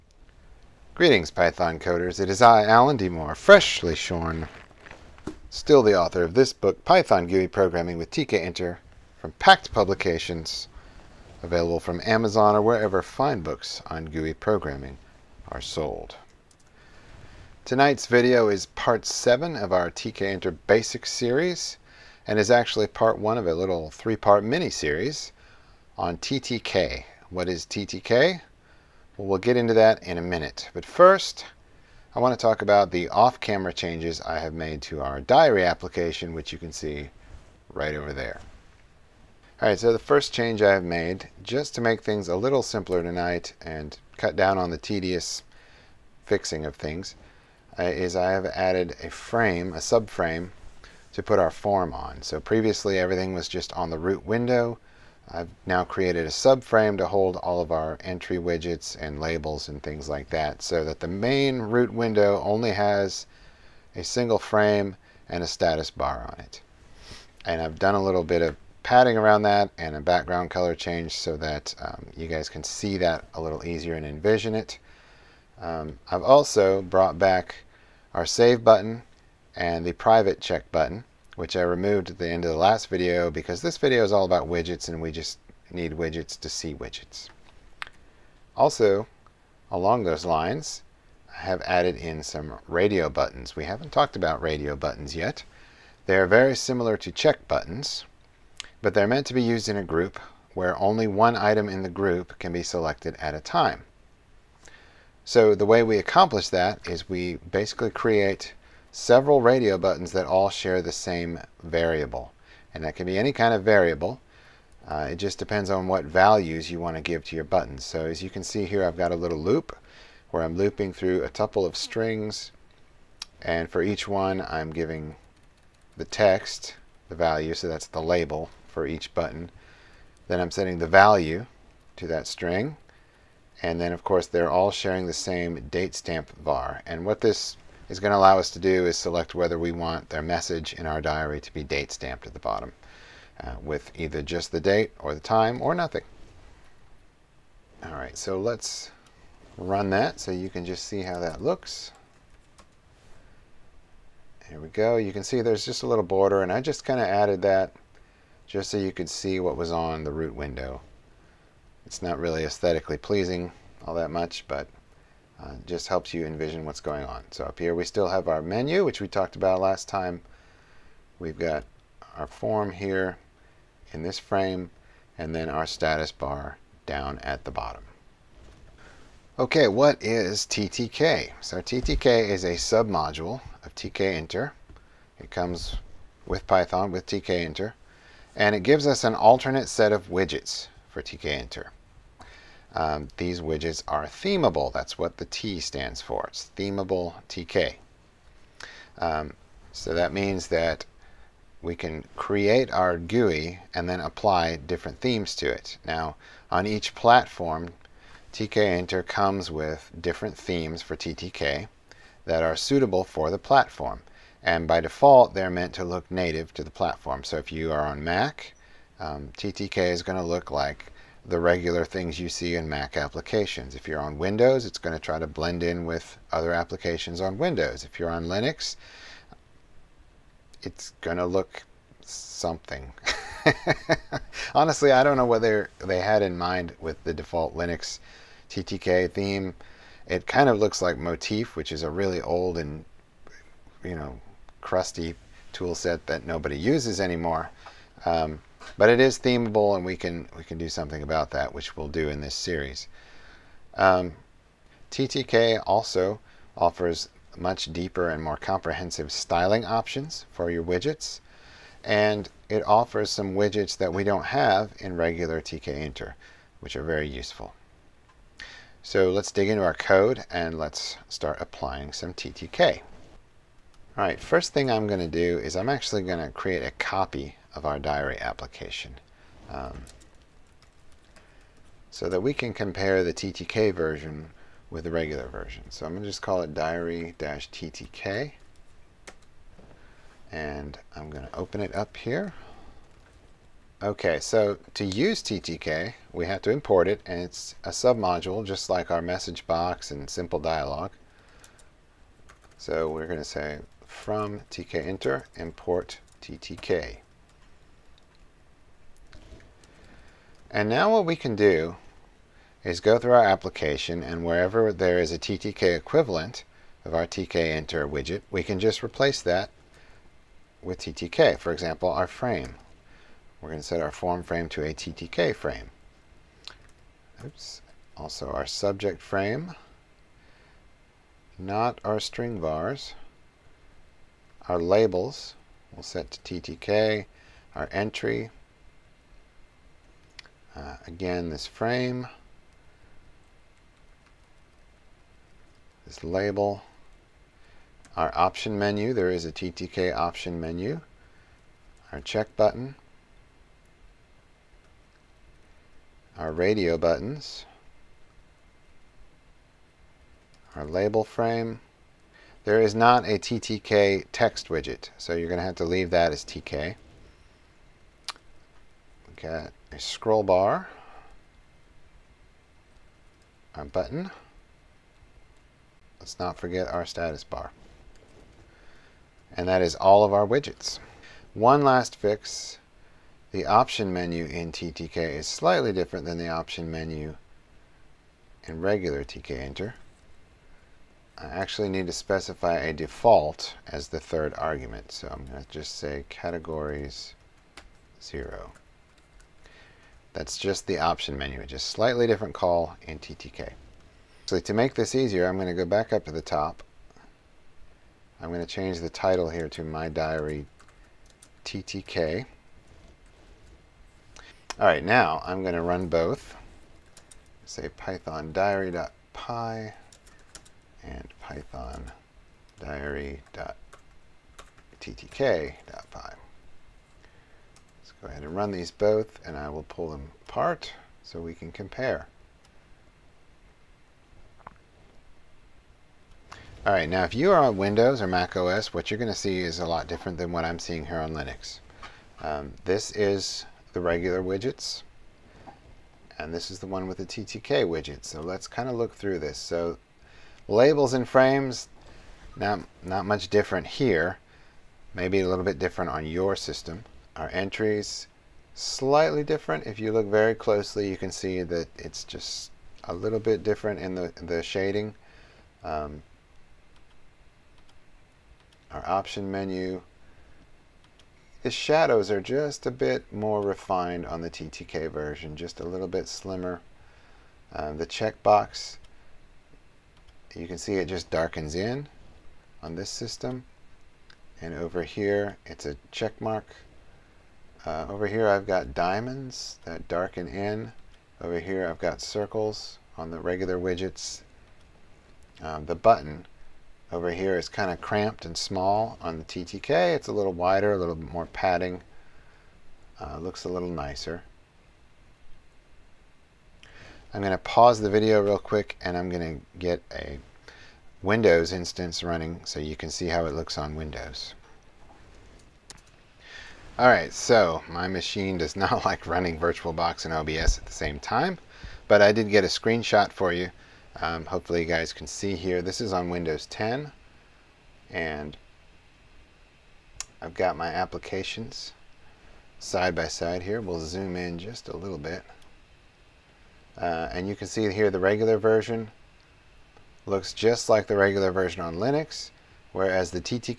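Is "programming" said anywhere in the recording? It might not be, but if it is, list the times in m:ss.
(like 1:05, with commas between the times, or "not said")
0:07, 0:14.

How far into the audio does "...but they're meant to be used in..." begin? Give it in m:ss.
1:38.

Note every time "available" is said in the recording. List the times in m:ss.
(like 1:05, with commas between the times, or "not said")
0:11.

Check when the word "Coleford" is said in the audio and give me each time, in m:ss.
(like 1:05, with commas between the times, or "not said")
not said.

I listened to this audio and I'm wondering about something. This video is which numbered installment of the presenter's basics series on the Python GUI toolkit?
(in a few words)
Part 7.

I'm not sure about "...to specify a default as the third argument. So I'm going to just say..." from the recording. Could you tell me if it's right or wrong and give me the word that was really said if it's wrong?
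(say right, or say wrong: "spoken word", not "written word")
right.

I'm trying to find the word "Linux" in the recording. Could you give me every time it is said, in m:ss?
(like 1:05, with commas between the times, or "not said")
3:48, 3:57, 7:21, 9:01.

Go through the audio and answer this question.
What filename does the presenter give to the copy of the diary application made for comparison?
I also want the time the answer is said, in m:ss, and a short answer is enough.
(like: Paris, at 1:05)
diary-ttk, at 4:46.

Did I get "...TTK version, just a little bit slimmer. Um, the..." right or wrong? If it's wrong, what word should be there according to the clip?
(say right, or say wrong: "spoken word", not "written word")
right.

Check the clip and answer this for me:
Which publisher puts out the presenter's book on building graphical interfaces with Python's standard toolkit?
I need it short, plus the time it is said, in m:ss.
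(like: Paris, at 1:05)
Packt Publications, at 0:09.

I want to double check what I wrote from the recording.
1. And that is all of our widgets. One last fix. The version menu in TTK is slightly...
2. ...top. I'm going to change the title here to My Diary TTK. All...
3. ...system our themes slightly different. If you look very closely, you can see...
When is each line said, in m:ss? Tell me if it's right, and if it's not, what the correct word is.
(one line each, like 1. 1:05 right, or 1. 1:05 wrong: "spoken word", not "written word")
1. 6:19 wrong: "option", not "version"
2. 6:46 right
3. 7:36 wrong: "entries", not "themes".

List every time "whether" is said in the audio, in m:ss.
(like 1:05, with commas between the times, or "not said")
2:19, 3:55.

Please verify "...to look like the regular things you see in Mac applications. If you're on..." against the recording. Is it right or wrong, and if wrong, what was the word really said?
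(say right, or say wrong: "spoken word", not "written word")
right.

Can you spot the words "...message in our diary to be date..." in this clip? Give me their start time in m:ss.
2:20.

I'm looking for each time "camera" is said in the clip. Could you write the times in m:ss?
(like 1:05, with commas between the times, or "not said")
0:33.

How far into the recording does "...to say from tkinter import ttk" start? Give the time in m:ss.
5:03.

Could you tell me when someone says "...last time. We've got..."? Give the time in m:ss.
2:49.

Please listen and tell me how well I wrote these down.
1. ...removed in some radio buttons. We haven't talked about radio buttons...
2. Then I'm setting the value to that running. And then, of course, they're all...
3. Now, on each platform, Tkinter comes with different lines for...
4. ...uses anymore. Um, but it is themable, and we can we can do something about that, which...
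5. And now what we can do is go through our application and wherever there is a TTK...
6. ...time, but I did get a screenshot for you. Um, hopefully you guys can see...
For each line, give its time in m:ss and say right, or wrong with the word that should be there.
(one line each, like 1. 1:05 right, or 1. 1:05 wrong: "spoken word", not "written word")
1. 1:31 wrong: "added", not "removed"
2. 2:10 wrong: "string", not "running"
3. 3:25 wrong: "themes", not "lines"
4. 4:06 right
5. 5:10 right
6. 8:40 right.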